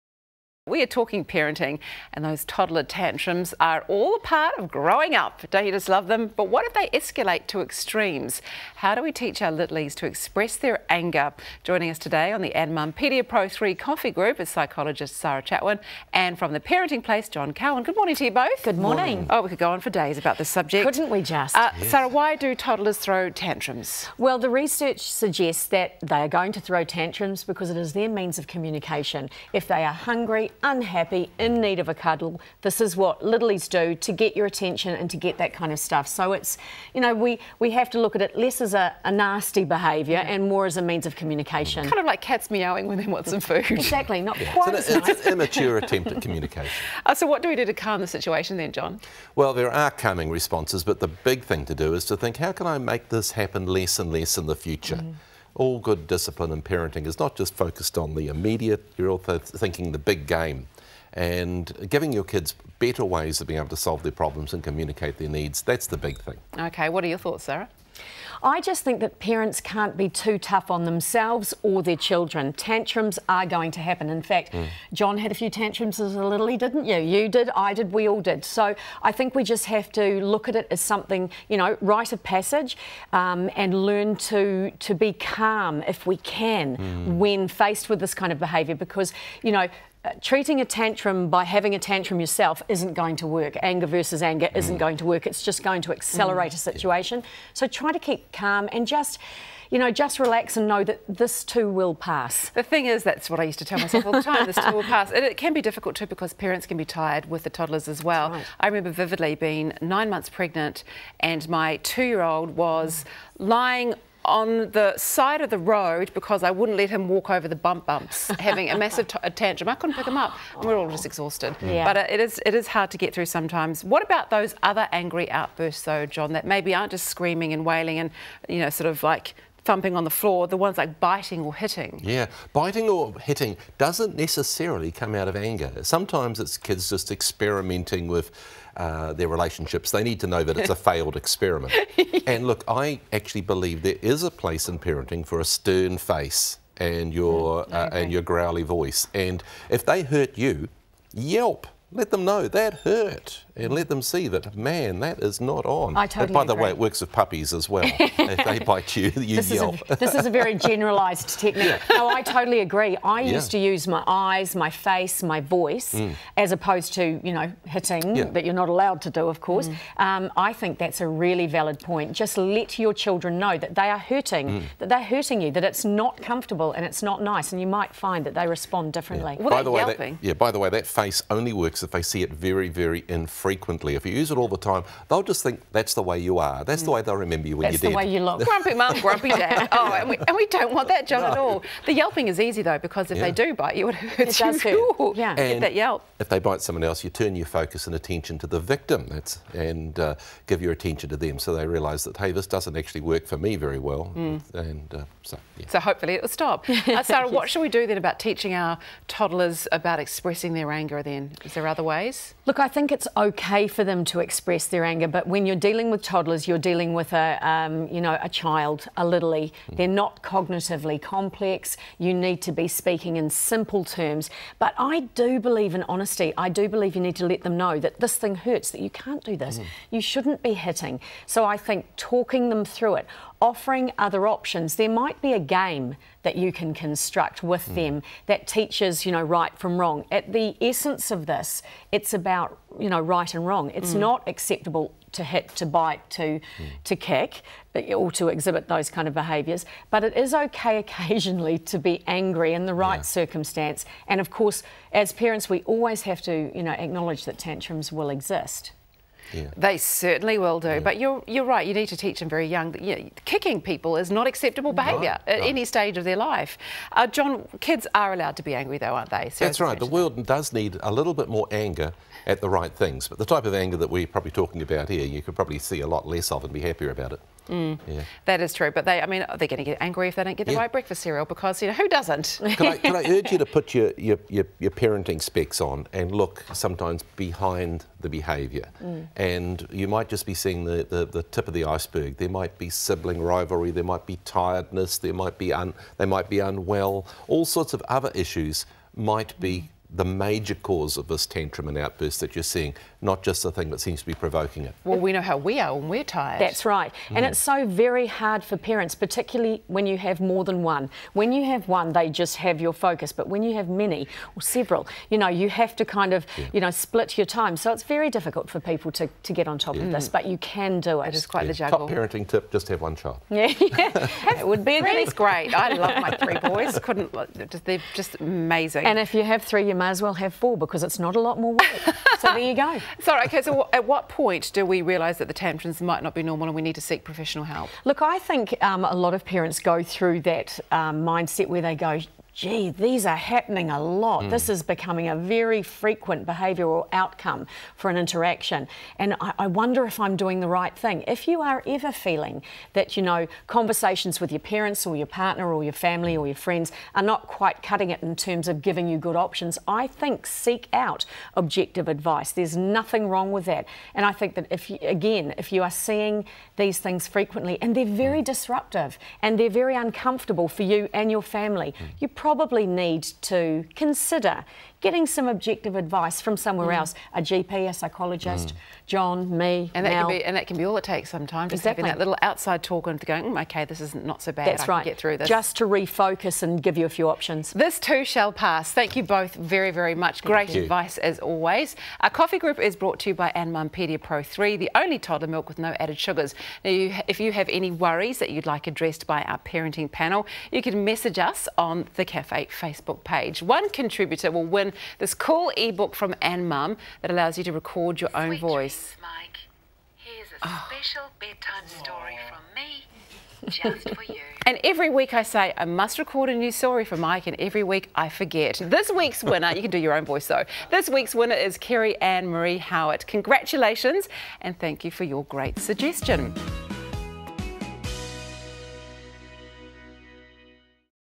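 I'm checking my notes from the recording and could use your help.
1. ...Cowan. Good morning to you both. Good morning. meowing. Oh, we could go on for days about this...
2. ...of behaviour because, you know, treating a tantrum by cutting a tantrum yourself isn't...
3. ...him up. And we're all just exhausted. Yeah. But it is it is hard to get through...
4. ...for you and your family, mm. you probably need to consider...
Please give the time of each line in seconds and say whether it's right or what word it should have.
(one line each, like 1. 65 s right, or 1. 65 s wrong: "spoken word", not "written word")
1. 17 s wrong: "morning", not "meowing"
2. 88 s wrong: "having", not "cutting"
3. 120 s right
4. 370 s right.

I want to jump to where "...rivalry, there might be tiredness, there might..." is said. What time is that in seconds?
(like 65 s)
293 s.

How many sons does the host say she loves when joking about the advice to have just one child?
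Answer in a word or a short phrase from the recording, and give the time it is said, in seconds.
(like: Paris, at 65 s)
3, at 326 s.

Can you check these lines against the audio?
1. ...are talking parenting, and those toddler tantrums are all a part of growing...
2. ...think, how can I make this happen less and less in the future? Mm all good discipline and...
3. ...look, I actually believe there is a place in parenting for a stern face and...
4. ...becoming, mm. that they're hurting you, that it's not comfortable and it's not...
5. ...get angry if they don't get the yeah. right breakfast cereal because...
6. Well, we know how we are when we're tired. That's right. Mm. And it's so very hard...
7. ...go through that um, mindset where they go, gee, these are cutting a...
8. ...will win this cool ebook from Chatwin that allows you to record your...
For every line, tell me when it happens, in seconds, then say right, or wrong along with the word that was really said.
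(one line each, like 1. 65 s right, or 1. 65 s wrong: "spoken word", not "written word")
1. 0 s right
2. 52 s right
3. 142 s right
4. 173 s wrong: "hurting", not "becoming"
5. 279 s right
6. 304 s right
7. 339 s wrong: "happening", not "cutting"
8. 404 s wrong: "Anmum", not "Chatwin".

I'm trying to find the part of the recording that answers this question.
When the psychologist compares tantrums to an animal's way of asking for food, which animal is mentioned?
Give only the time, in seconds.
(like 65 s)
42 s.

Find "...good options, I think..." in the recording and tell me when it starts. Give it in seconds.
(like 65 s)
358 s.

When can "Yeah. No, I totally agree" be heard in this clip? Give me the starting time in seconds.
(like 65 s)
161 s.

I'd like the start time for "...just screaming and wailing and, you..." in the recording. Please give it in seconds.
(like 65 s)
126 s.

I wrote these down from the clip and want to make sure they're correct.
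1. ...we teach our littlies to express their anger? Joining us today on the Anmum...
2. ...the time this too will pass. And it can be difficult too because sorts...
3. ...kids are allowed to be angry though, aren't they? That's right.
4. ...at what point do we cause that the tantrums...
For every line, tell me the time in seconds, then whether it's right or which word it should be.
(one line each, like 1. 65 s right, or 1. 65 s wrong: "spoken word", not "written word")
1. 9 s right
2. 104 s wrong: "parents", not "sorts"
3. 267 s right
4. 333 s wrong: "realise", not "cause".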